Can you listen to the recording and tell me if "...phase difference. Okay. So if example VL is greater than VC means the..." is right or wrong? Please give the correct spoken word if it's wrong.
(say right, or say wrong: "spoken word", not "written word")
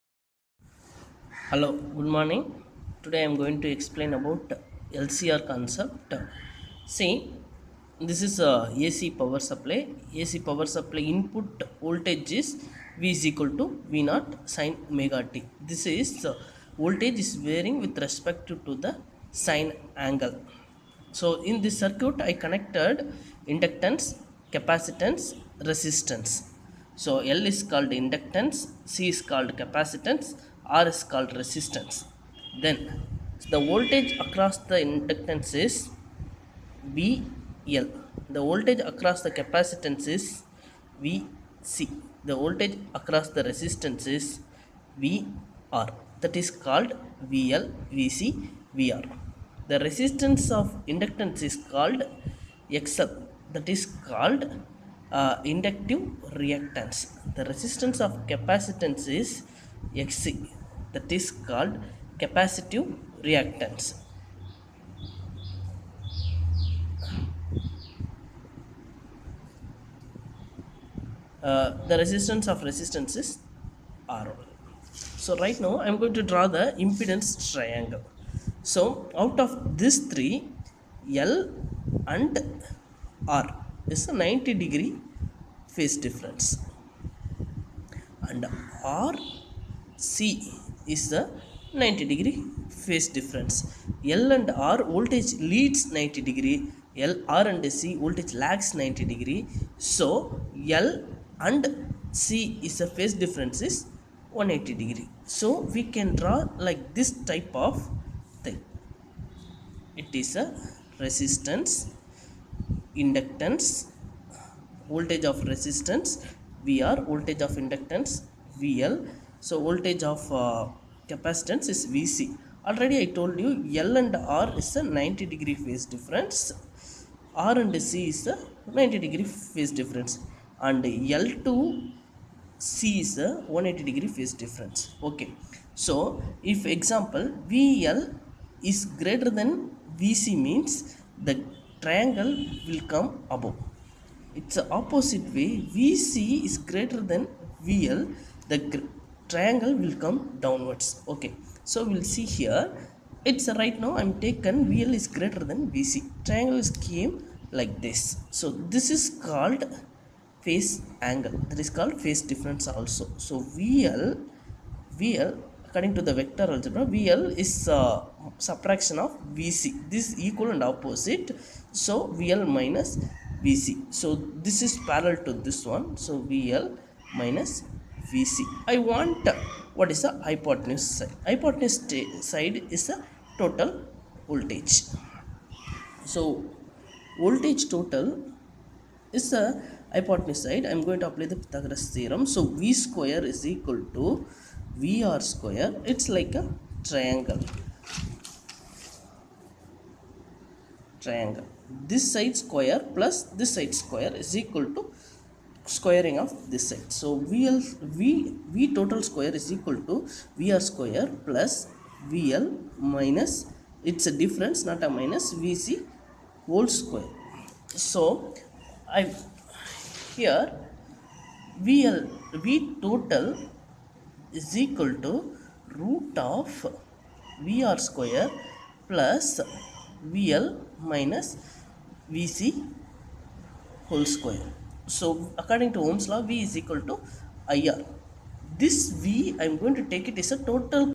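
right.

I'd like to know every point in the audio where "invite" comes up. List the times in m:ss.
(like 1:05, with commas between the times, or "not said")
not said.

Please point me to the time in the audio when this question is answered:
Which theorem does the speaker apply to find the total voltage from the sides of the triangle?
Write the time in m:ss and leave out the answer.
3:11.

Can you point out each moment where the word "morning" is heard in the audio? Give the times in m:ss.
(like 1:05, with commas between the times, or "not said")
0:02.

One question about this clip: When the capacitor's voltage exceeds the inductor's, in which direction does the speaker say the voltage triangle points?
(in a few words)
Downwards.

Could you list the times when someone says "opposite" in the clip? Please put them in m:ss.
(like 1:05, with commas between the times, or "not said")
2:24, 2:50.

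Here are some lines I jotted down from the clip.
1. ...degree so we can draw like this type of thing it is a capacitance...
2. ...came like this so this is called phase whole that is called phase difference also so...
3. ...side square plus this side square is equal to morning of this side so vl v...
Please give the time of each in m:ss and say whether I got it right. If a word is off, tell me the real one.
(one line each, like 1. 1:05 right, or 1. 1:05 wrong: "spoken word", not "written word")
1. 1:44 wrong: "resistance", not "capacitance"
2. 2:36 wrong: "angle", not "whole"
3. 3:22 wrong: "squaring", not "morning".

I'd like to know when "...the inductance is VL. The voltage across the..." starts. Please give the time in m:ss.
0:34.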